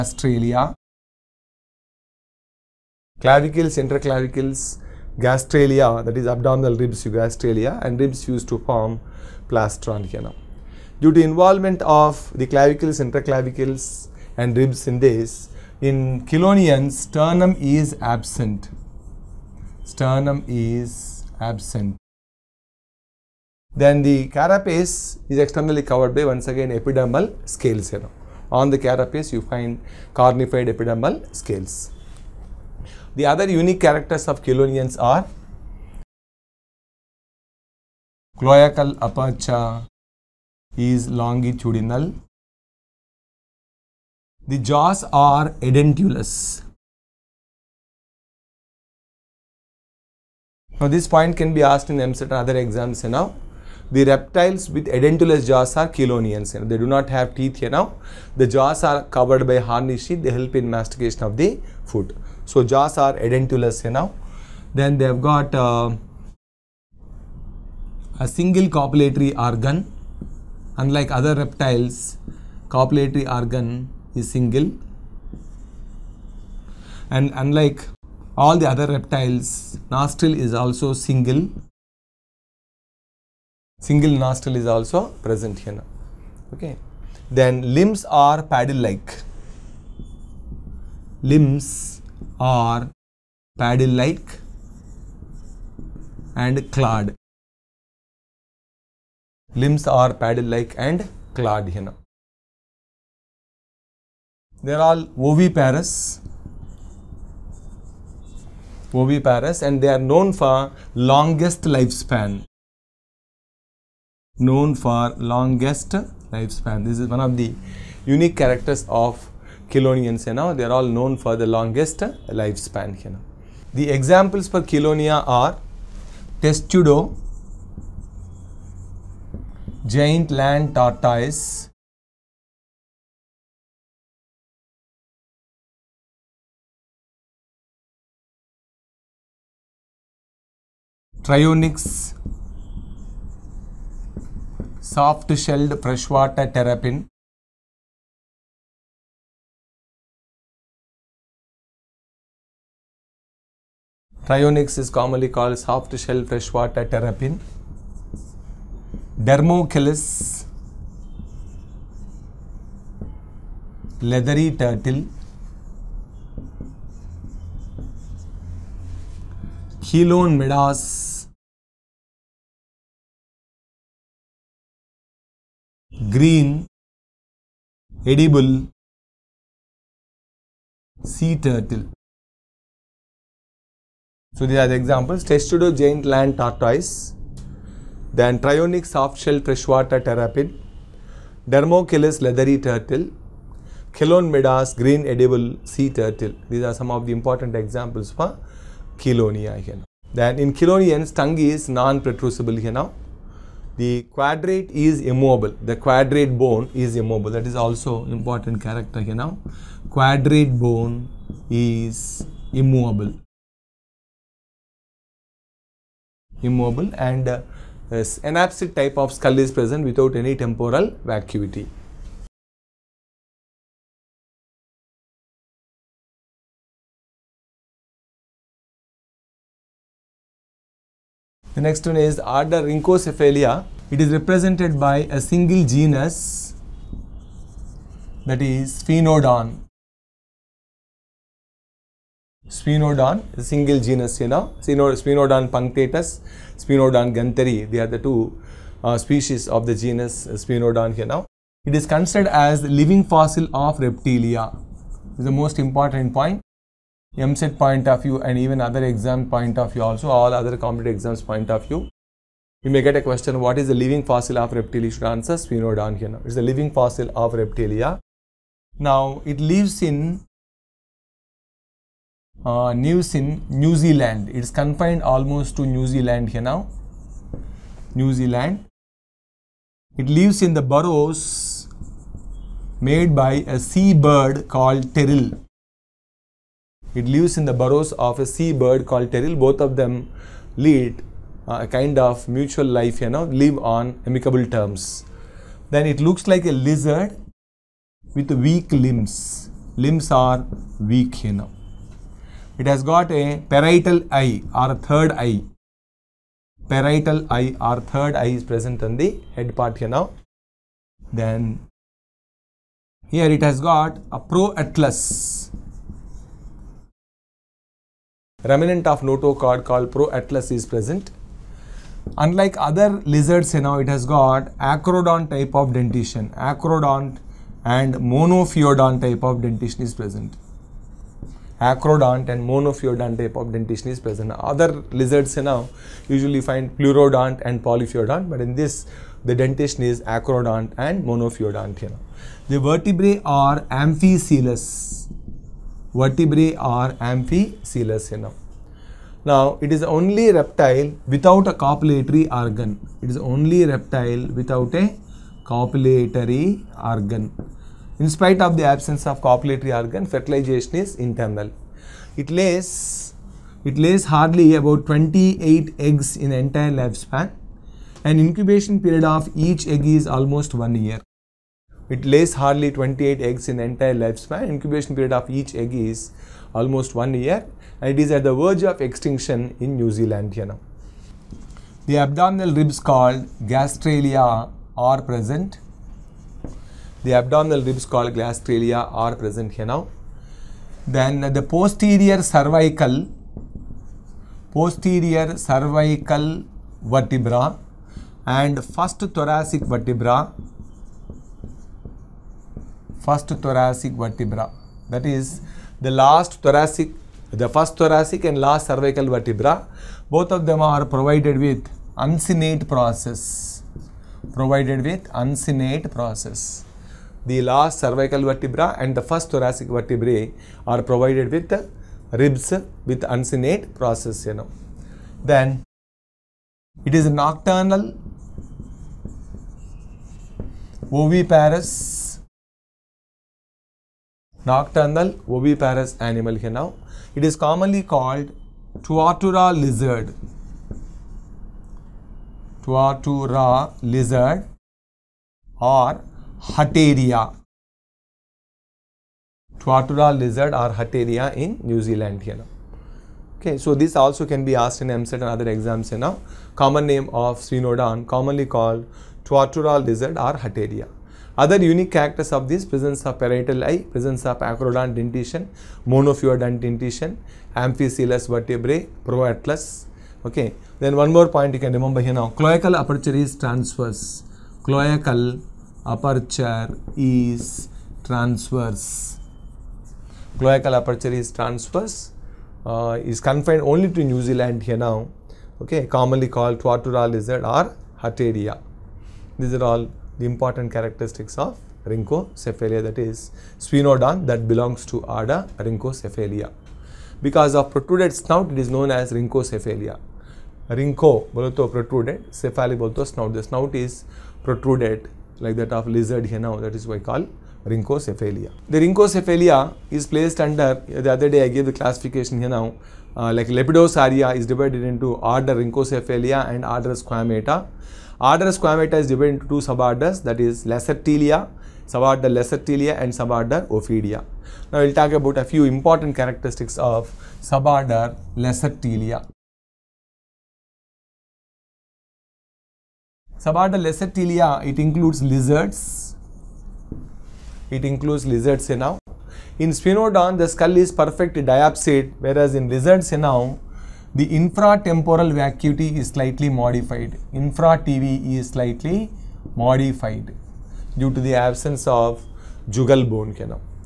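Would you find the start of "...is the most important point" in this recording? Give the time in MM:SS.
04:15.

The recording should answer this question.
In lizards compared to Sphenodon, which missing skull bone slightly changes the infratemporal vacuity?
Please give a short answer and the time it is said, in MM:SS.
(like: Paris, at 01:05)
jugal bone, at 09:12.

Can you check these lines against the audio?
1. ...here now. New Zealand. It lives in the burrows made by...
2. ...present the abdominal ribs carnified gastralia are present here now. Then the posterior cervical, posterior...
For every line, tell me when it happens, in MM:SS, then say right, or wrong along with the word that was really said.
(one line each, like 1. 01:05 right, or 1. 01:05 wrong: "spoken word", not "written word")
1. 04:36 right
2. 06:25 wrong: "called", not "carnified".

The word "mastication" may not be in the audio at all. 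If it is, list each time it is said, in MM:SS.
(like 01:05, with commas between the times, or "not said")
01:00.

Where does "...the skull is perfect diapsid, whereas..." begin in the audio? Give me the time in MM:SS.
09:00.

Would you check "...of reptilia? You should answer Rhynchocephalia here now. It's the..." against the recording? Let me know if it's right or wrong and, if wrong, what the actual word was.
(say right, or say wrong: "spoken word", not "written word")
wrong: "Sphenodon", not "Rhynchocephalia".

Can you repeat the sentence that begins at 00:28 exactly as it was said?
On the carapace, you find carnified epidermal scales.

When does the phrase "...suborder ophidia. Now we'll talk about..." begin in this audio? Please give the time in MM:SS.
08:43.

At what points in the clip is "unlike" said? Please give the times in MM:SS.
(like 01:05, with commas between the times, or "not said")
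01:10, 01:17, 05:22.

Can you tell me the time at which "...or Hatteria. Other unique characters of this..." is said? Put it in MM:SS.
07:40.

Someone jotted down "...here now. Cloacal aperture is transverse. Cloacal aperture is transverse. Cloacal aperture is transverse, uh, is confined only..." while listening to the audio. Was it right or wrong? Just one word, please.
right.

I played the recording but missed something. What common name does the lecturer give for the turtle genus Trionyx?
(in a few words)
soft shelled freshwater terrapin.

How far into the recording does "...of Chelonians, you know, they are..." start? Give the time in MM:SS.
01:58.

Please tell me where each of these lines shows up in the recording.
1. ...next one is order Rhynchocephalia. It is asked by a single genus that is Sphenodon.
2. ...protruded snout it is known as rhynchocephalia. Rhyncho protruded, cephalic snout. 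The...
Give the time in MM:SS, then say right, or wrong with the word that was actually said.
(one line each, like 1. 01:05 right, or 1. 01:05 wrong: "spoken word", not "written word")
1. 03:51 wrong: "represented", not "asked"
2. 08:17 right.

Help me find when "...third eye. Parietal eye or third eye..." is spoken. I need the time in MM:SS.
05:04.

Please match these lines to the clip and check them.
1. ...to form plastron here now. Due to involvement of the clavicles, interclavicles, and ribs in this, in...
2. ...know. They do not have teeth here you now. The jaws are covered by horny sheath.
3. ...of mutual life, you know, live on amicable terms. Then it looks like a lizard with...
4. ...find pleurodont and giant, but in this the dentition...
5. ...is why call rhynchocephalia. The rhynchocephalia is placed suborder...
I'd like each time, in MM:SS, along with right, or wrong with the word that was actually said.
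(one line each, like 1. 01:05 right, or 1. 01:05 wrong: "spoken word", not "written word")
1. 00:08 right
2. 00:56 right
3. 04:51 right
4. 05:36 wrong: "polyphyodont", not "giant"
5. 08:26 wrong: "under", not "suborder".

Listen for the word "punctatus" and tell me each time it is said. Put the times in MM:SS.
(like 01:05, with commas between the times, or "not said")
04:05.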